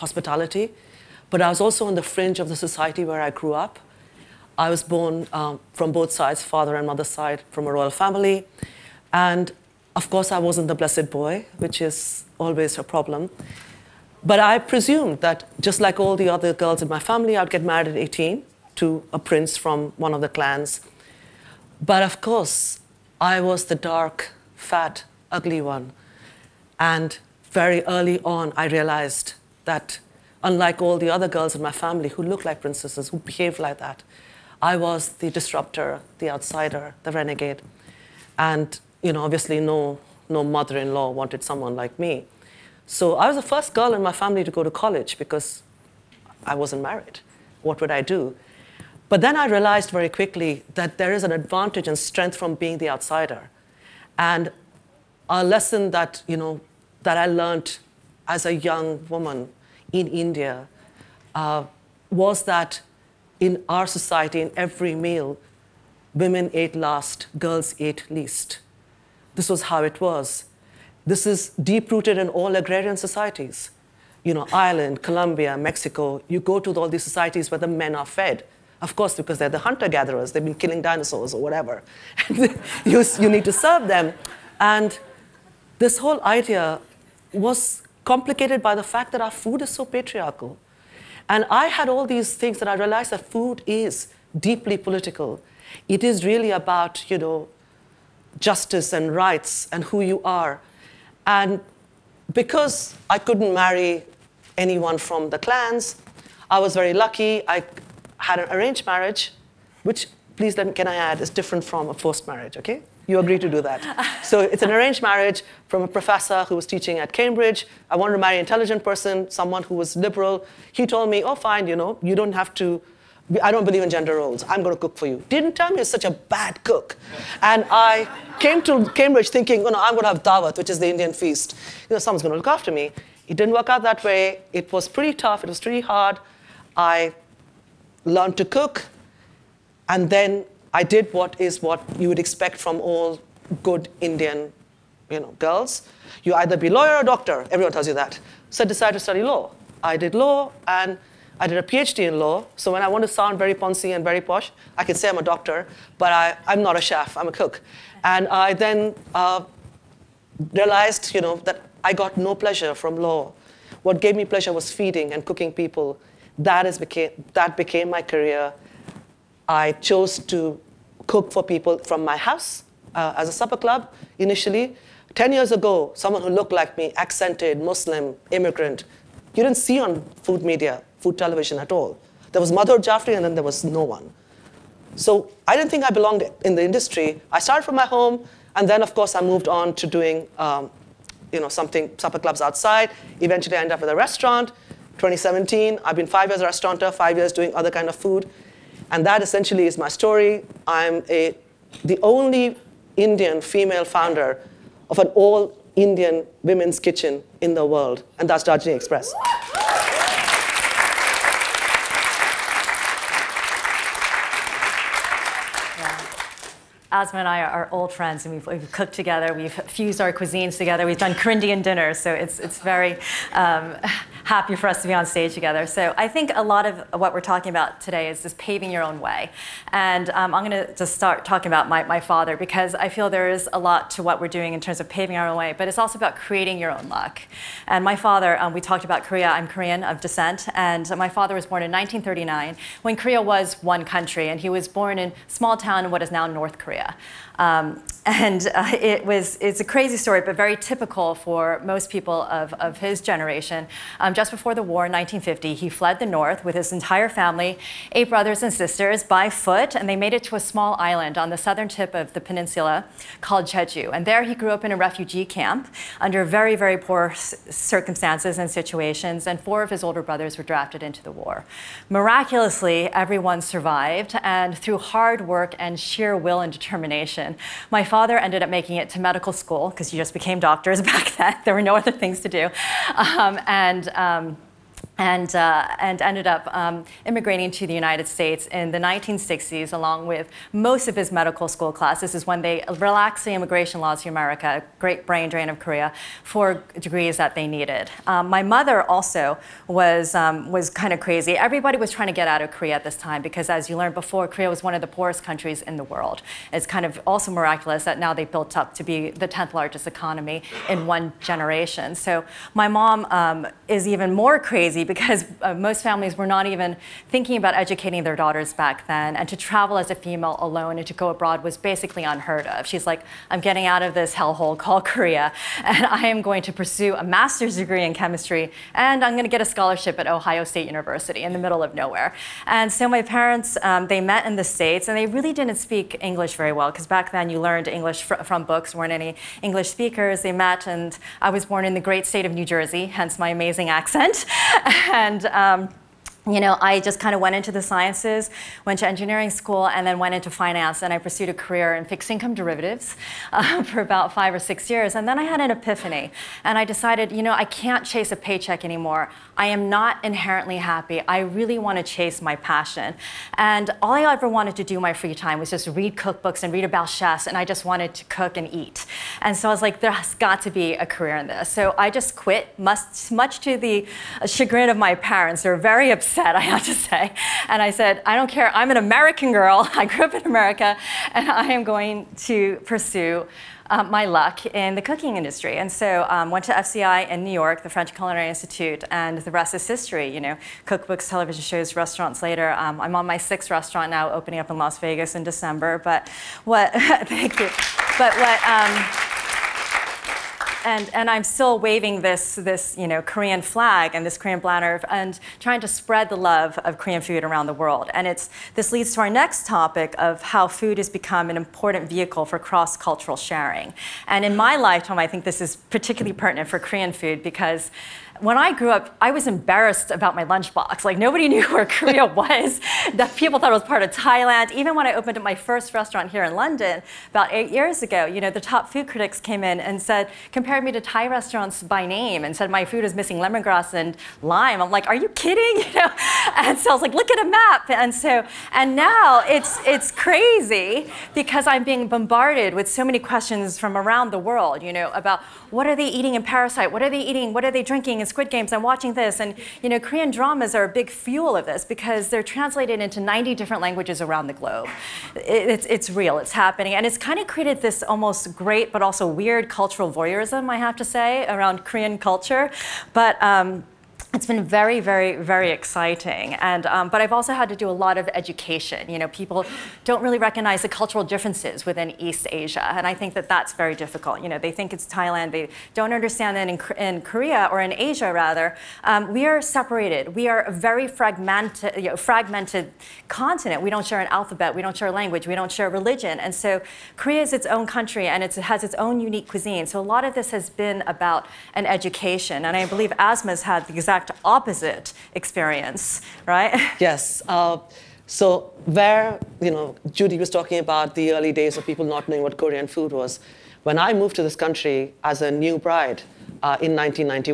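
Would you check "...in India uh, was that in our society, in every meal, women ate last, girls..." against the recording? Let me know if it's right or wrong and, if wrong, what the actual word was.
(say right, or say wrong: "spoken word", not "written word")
right.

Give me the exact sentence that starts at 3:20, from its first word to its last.
I'm a, the only Indian female founder of an all Indian women's kitchen in the world, and that's Darjeeling Express.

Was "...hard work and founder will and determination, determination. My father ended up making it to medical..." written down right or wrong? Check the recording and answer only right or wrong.
wrong.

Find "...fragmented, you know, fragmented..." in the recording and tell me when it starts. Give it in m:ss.
8:00.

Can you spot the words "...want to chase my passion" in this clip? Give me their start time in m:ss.
6:01.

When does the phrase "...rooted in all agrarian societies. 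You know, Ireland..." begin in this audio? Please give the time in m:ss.
1:11.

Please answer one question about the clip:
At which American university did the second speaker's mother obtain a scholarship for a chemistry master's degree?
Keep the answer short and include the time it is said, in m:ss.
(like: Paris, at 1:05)
Ohio State University, at 5:30.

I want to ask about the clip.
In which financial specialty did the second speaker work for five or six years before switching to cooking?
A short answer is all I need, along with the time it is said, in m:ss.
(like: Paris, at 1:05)
fixed income derivatives, at 5:51.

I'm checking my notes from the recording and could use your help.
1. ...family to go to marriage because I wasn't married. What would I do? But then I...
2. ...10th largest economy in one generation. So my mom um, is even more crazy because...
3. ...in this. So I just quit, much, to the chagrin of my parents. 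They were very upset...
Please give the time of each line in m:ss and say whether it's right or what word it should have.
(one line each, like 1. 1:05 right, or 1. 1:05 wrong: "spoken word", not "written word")
1. 0:44 wrong: "college", not "marriage"
2. 5:09 right
3. 6:11 right.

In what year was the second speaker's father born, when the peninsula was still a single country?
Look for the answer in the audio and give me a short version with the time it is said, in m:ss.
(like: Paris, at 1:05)
1939, at 4:01.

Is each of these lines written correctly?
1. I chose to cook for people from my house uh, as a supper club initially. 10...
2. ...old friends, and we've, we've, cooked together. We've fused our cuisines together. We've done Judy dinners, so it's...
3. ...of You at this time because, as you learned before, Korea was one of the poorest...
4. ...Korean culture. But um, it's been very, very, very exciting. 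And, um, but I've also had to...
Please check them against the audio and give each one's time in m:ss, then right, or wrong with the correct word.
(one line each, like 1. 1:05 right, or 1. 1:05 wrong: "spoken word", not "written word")
1. 2:49 right
2. 3:37 wrong: "Korean", not "Judy"
3. 5:02 wrong: "Korea", not "You"
4. 7:41 right.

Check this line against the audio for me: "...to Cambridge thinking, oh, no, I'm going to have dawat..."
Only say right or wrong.
right.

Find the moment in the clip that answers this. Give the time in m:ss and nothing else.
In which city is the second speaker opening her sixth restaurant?
6:34.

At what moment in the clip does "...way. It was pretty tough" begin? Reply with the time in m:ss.
2:14.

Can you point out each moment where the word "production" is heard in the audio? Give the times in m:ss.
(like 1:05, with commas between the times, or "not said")
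not said.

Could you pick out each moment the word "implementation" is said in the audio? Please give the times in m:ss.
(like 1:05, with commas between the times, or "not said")
not said.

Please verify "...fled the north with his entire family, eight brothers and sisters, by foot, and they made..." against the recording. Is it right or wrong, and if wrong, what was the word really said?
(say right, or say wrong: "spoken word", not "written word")
right.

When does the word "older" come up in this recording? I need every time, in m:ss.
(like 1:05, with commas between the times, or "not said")
4:29.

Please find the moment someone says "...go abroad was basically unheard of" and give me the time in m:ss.
5:20.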